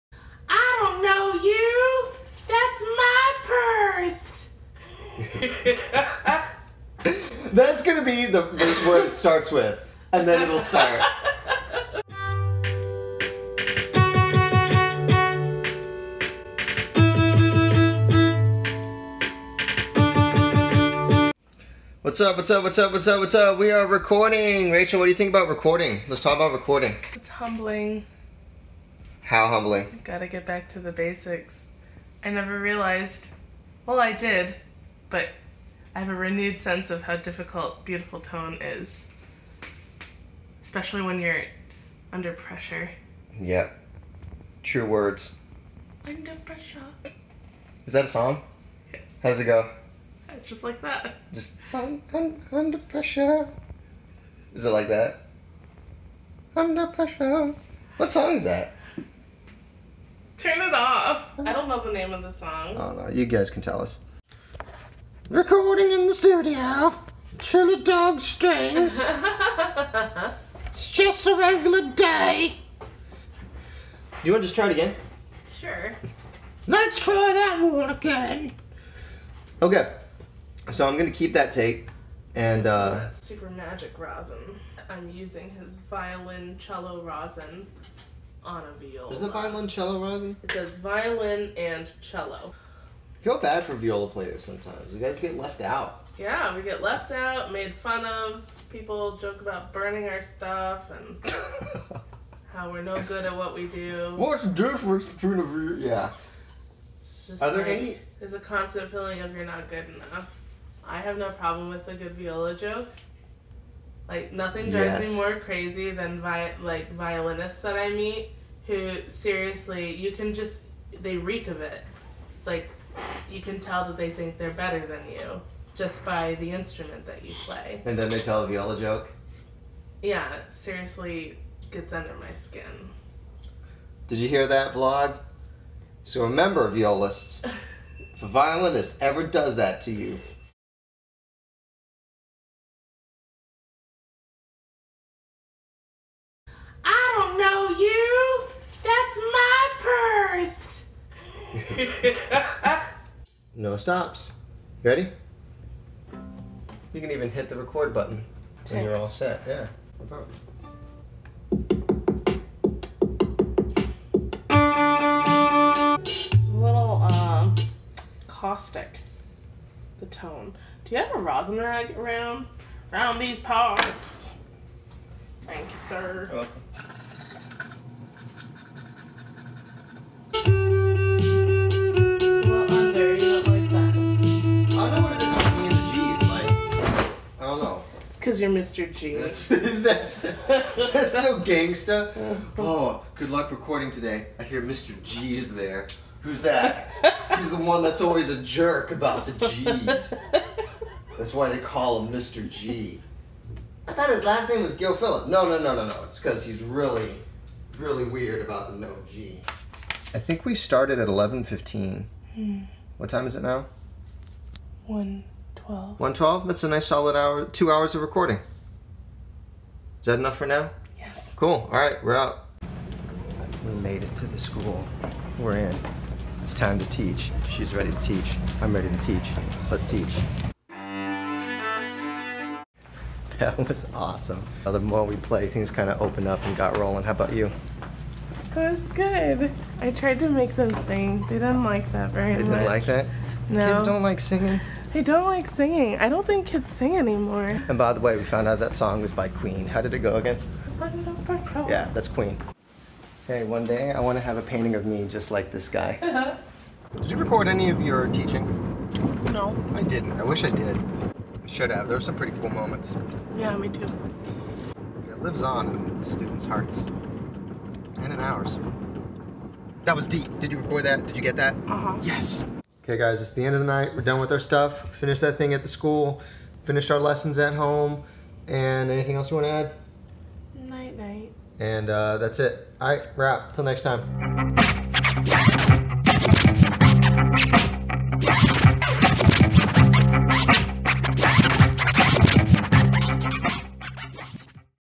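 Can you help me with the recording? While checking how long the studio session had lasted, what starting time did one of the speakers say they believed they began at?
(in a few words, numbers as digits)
11:15.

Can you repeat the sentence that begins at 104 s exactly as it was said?
What's the difference between a viola?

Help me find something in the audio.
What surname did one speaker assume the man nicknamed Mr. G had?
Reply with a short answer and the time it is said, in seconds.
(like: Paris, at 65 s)
Gilfillan, at 204 s.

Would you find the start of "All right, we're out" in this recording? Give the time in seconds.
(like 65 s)
221 s.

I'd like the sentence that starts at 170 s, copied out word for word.
Do you have a rosin rag around?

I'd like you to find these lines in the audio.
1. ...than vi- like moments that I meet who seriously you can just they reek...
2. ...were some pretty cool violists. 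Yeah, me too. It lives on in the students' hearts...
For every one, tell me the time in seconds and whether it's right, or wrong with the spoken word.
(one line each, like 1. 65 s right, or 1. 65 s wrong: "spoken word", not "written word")
1. 115 s wrong: "violinists", not "moments"
2. 261 s wrong: "moments", not "violists".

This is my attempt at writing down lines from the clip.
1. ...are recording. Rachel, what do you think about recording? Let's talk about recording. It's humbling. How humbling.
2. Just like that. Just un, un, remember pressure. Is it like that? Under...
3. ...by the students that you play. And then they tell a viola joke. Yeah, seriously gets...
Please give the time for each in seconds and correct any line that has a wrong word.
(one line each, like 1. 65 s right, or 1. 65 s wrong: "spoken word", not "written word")
1. 23 s right
2. 50 s wrong: "under", not "remember"
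3. 126 s wrong: "instrument", not "students".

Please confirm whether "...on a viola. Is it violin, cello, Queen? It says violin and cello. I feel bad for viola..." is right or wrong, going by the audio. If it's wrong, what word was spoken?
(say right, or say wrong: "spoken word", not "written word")
wrong: "Rosie", not "Queen".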